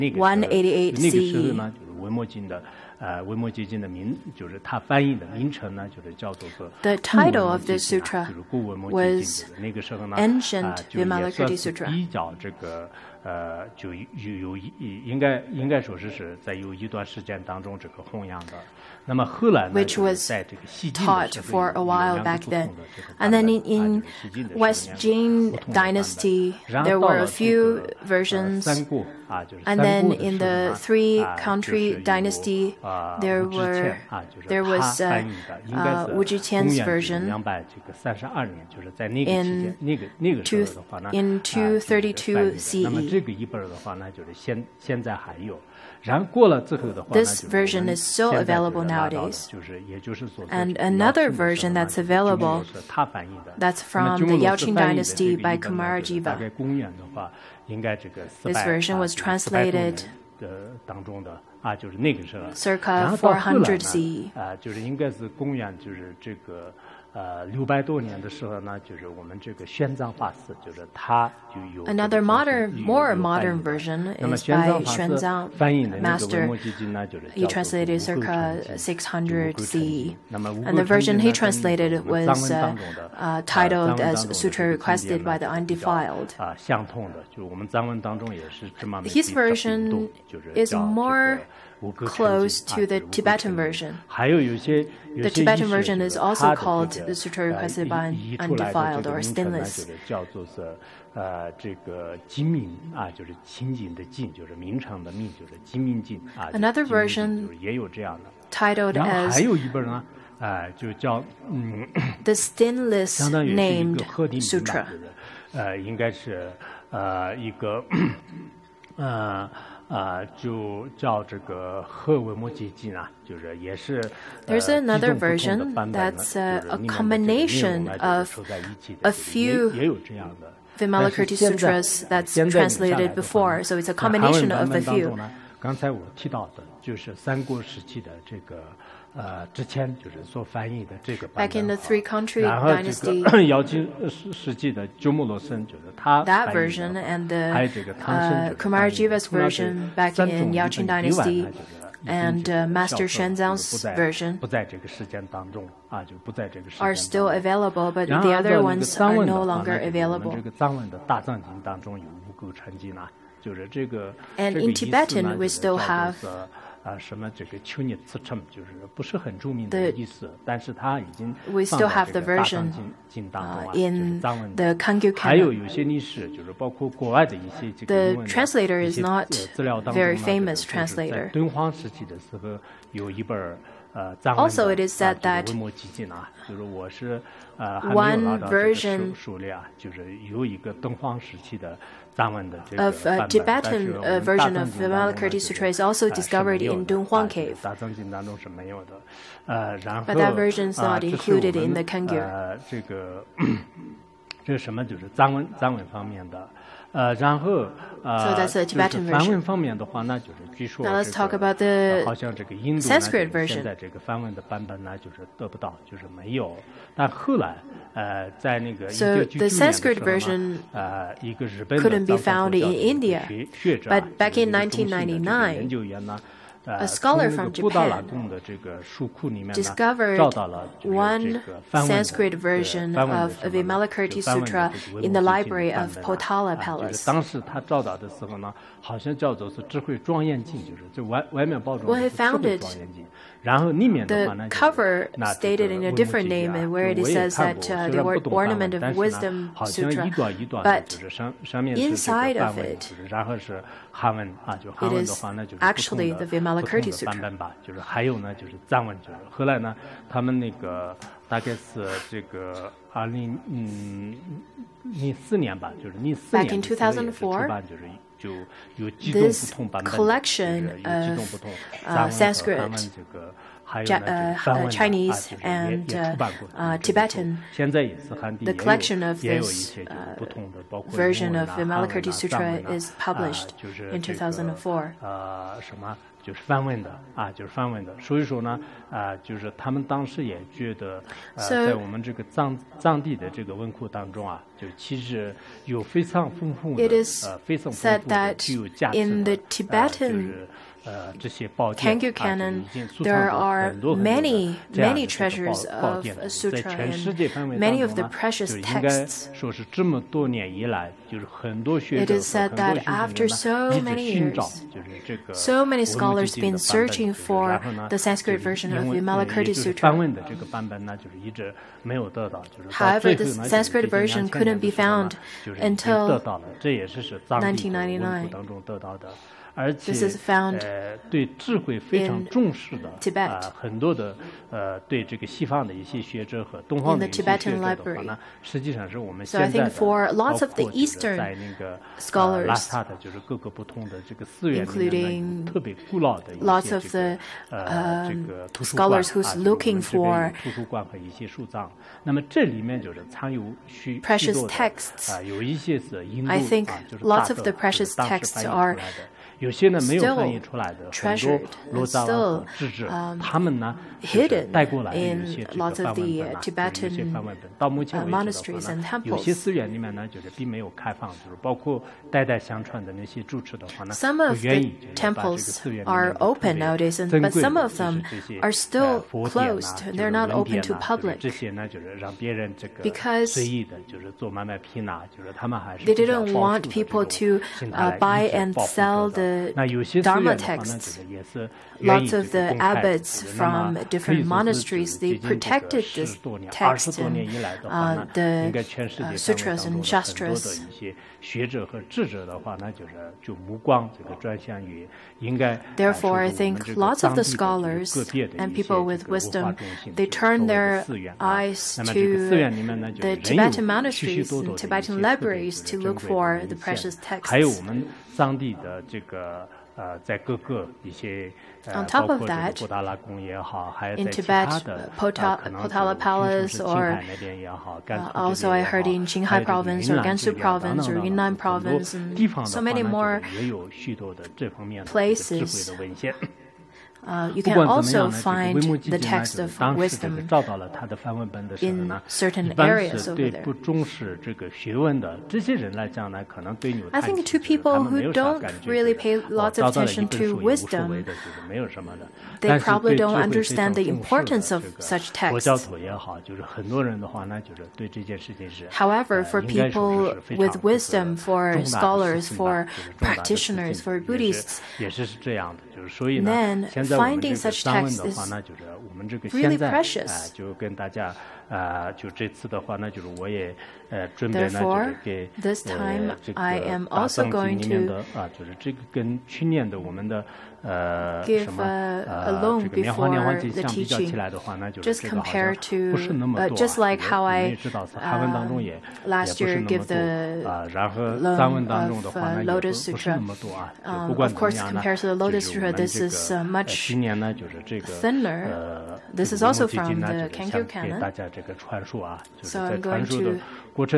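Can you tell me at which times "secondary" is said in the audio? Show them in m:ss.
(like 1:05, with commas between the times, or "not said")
not said.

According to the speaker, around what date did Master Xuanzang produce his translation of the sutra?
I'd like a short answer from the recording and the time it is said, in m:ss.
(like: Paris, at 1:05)
circa 600 CE, at 1:18.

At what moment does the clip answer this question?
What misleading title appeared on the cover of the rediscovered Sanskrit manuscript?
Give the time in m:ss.
4:08.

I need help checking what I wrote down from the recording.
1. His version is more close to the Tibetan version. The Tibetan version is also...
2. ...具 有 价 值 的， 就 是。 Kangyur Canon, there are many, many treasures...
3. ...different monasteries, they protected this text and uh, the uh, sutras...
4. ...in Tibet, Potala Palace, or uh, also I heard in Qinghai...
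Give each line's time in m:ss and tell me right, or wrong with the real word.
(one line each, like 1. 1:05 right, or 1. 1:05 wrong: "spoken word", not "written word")
1. 1:29 right
2. 4:58 right
3. 6:33 right
4. 7:02 right.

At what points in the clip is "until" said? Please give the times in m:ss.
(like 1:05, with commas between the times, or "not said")
5:25.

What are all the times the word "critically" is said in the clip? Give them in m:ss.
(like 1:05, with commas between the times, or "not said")
not said.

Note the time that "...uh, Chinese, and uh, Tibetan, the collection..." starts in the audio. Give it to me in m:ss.
4:33.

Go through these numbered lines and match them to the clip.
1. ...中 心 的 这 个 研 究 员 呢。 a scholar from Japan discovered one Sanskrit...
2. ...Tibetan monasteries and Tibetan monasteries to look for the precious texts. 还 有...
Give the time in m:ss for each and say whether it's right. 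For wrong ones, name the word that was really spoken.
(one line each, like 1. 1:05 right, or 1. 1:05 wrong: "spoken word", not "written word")
1. 3:43 right
2. 6:53 wrong: "libraries", not "monasteries".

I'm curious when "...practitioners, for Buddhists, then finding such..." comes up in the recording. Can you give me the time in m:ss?
7:42.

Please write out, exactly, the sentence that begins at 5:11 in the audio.
It is said that after so many years, so many scholars have been searching for the Sanskrit version of Vimalakirti Sutra.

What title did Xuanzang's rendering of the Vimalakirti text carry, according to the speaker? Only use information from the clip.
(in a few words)
Sutra Requested by the Undefiled.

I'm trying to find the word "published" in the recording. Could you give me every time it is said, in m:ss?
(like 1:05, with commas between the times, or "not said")
4:42.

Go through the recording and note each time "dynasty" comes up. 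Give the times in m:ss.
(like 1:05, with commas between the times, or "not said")
0:25, 0:32, 0:54, 2:19.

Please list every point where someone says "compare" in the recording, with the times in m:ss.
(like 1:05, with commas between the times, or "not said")
8:05.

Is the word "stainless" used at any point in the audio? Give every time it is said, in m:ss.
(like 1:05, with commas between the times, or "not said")
1:39, 1:52.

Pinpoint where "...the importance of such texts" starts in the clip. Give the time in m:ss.
7:33.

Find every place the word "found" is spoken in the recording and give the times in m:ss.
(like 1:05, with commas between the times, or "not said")
4:02, 5:24.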